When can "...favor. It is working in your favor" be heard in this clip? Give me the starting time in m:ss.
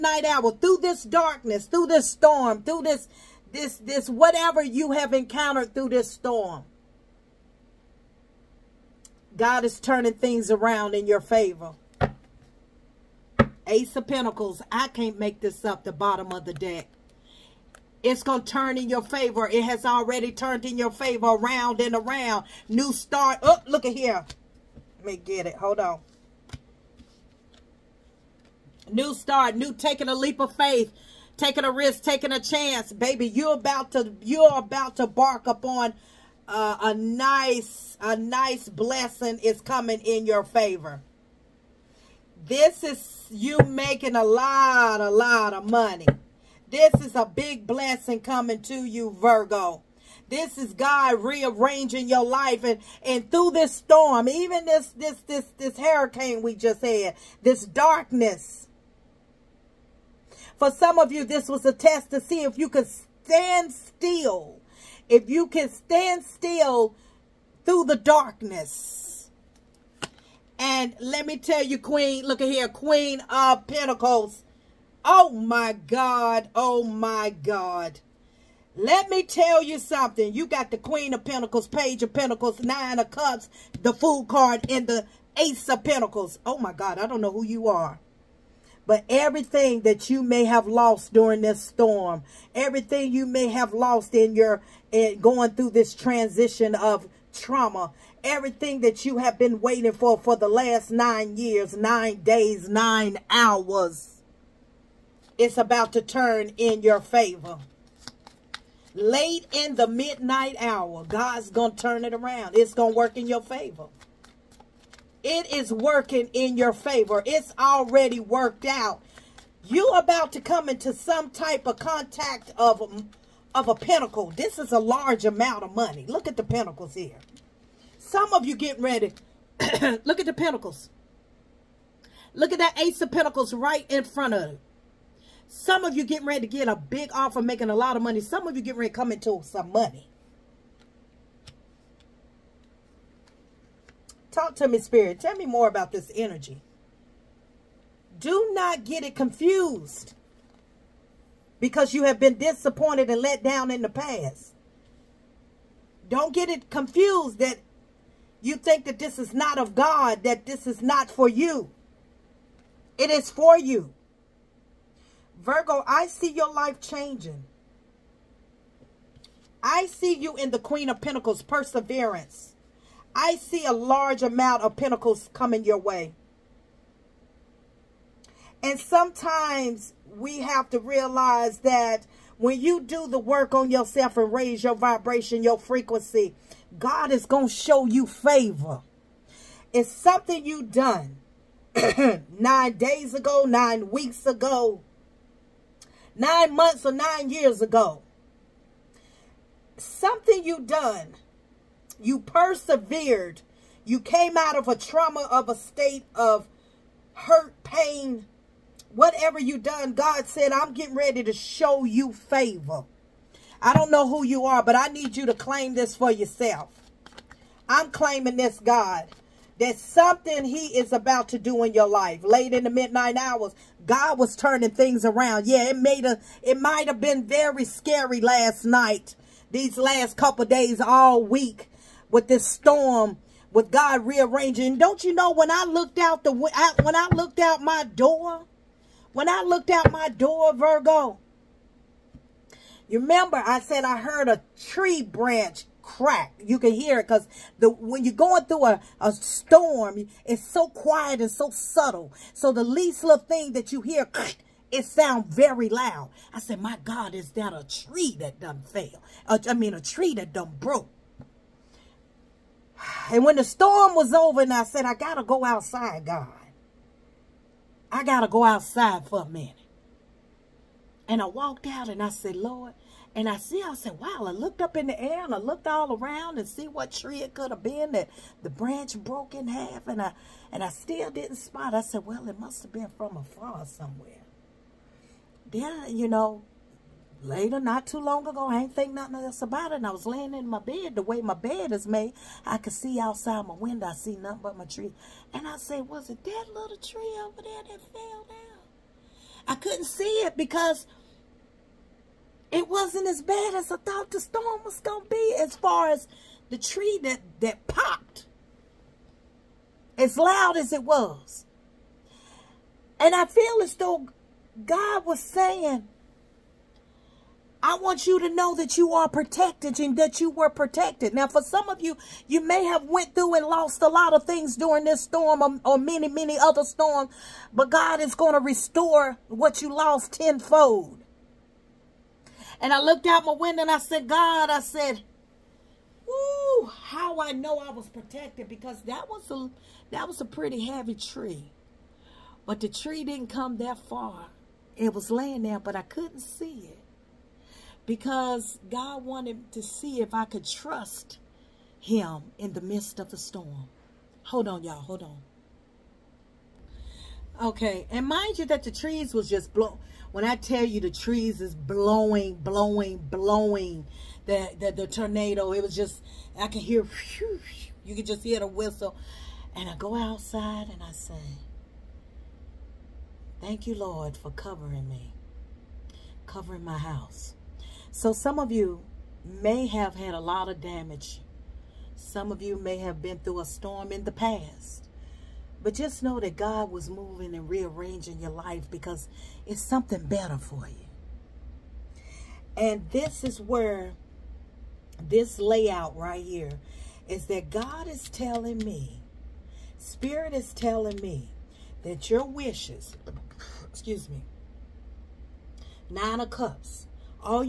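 1:53.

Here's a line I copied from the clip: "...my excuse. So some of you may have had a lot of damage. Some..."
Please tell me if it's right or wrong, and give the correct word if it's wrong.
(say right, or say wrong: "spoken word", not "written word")
wrong: "house", not "excuse".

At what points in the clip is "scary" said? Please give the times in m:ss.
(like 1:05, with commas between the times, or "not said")
3:47.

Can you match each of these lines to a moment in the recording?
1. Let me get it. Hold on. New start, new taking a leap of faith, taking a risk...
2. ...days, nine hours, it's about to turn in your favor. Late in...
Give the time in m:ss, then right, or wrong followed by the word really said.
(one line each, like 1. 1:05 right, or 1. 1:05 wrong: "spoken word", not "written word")
1. 0:24 right
2. 1:42 right.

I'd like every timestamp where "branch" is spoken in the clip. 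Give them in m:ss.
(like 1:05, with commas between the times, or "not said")
4:05, 4:38.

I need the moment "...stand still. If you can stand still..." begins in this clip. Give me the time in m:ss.
1:03.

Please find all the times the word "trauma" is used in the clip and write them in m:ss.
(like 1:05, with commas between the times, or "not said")
1:37, 3:24.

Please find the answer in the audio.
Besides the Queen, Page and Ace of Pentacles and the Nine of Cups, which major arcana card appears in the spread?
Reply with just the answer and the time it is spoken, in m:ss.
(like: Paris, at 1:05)
The Fool, at 1:23.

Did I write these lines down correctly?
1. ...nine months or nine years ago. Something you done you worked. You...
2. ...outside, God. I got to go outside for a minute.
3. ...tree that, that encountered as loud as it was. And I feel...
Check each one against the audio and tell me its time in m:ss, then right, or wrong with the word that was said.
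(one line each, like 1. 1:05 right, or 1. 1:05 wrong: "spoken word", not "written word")
1. 3:16 wrong: "persevered", not "worked"
2. 4:25 right
3. 5:06 wrong: "popped", not "encountered".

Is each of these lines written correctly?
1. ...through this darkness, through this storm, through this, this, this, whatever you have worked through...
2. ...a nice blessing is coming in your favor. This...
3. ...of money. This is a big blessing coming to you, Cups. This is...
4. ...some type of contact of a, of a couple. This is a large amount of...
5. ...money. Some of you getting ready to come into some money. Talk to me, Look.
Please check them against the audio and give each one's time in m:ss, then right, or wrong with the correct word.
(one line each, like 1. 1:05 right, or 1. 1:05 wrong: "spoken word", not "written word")
1. 0:00 wrong: "encountered", not "worked"
2. 0:38 right
3. 0:45 wrong: "Virgo", not "Cups"
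4. 2:00 wrong: "pinnacle", not "couple"
5. 2:18 wrong: "Spirit", not "Look".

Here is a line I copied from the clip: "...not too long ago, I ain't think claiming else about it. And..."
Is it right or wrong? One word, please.
wrong.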